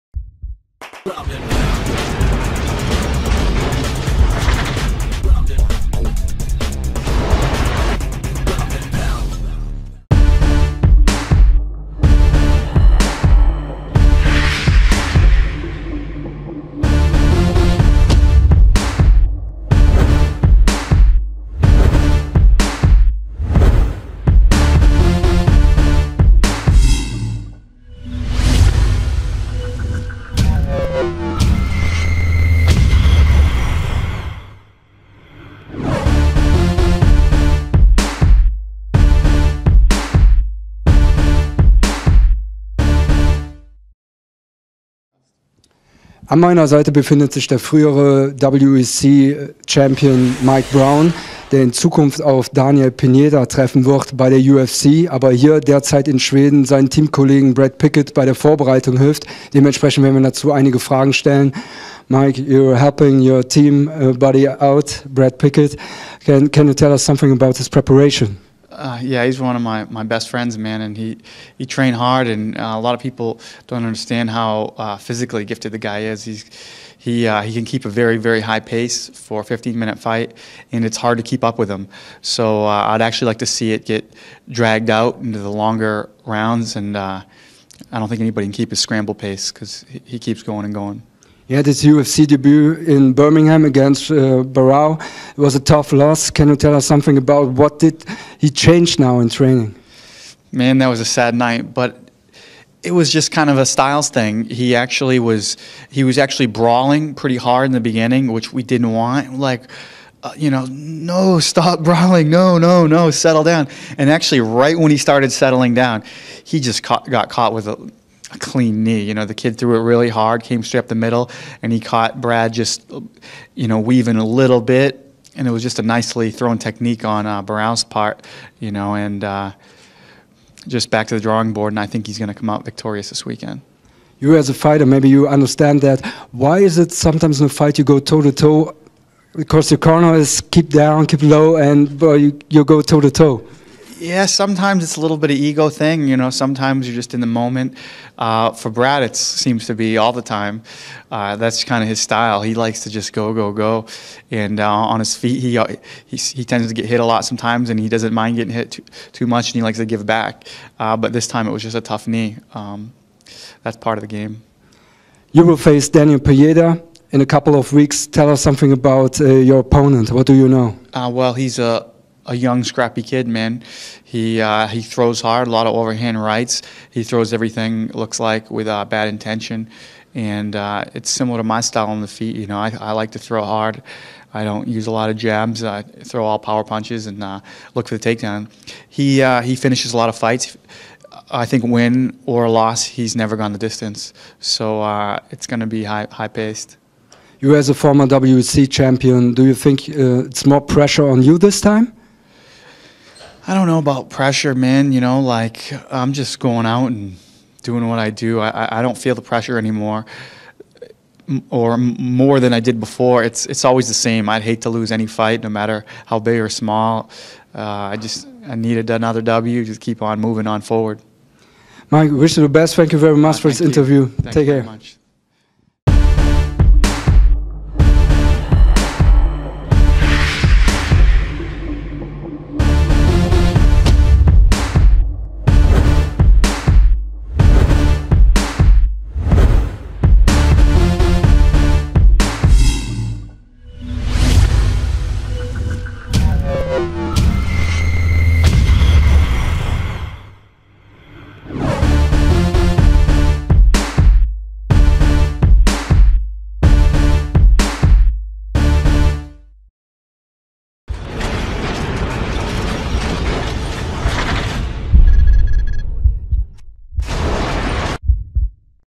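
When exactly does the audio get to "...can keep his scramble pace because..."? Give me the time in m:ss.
1:28.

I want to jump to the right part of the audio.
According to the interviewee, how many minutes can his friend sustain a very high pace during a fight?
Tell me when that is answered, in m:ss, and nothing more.
1:19.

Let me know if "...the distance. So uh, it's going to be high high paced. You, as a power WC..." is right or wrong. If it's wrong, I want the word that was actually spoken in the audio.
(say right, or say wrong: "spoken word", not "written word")
wrong: "former", not "power".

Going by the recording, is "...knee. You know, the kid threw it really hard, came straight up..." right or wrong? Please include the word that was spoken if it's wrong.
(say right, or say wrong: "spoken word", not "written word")
right.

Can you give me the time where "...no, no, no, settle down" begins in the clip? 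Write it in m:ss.
1:52.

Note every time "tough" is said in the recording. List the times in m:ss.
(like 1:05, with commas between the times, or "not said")
1:35, 2:41.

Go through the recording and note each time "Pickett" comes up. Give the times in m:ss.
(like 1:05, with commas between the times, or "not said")
0:57, 1:05.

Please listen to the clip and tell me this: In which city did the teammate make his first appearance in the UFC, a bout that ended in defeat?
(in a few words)
Birmingham.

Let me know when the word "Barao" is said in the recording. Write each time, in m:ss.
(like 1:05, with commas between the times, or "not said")
1:34, 2:07.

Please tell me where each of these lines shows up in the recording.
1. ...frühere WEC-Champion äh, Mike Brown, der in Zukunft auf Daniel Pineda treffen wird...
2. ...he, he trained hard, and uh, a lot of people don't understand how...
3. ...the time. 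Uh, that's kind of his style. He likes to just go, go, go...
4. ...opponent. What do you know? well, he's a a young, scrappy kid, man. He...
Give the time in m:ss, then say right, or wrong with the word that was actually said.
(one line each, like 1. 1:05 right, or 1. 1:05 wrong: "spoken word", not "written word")
1. 0:47 right
2. 1:10 right
3. 2:30 right
4. 2:49 right.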